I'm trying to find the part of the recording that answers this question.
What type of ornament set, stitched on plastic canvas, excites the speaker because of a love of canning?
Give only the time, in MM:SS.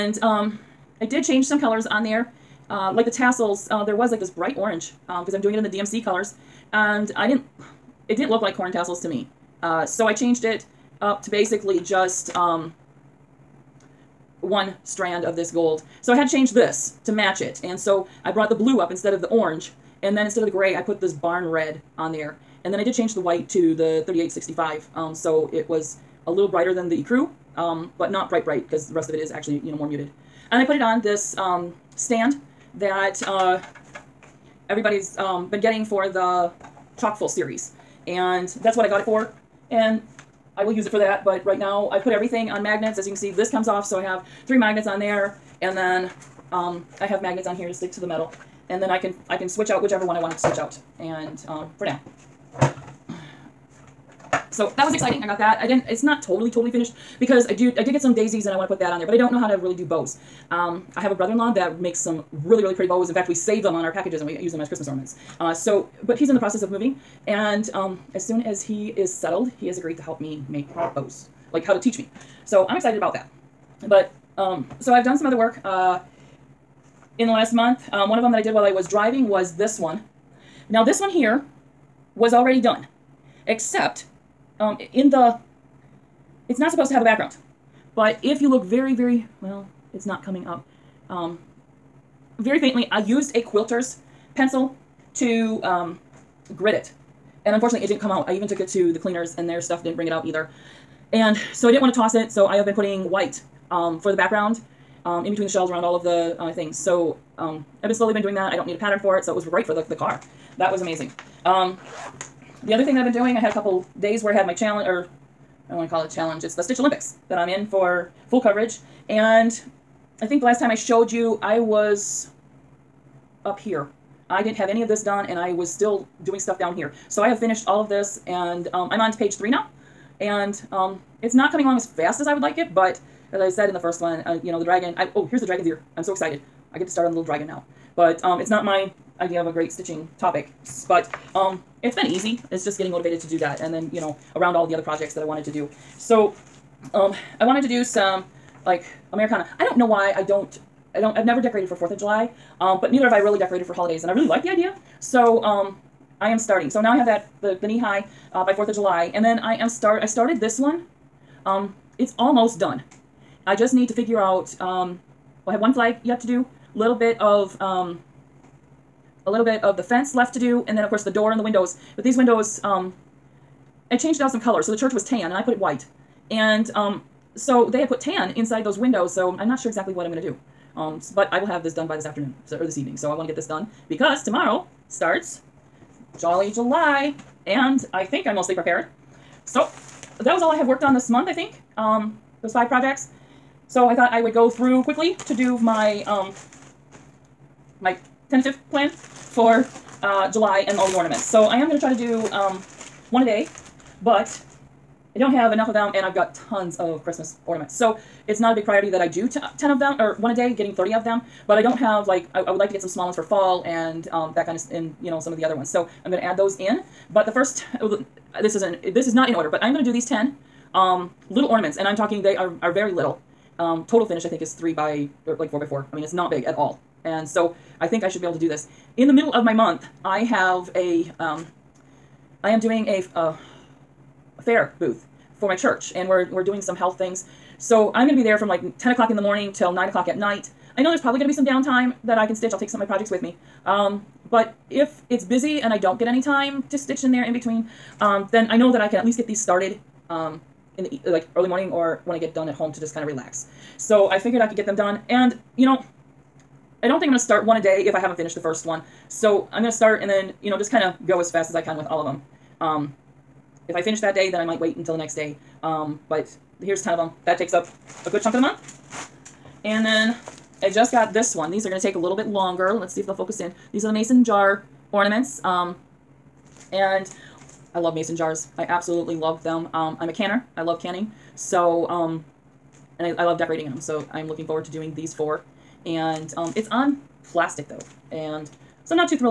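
04:33.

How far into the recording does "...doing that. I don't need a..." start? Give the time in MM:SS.
01:48.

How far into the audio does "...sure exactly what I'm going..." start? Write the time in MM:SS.
02:59.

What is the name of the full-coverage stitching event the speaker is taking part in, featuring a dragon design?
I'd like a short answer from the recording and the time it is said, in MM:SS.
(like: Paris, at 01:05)
Stitch Olympics, at 01:56.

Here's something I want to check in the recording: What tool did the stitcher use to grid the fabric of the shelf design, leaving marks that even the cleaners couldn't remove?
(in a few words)
quilter's pencil.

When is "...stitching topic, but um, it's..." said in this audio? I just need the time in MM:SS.
02:19.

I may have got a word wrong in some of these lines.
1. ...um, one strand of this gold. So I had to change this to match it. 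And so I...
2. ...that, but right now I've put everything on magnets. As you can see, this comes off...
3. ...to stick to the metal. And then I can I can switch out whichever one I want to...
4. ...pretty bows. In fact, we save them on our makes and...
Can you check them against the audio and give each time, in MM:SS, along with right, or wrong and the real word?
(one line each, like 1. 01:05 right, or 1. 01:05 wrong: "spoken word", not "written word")
1. 00:12 right
2. 00:40 right
3. 00:47 right
4. 01:02 wrong: "packages", not "makes".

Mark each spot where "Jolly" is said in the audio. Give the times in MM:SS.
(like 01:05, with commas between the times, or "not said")
03:06.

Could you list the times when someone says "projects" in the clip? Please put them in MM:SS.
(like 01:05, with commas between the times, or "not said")
02:24, 03:12, 04:02.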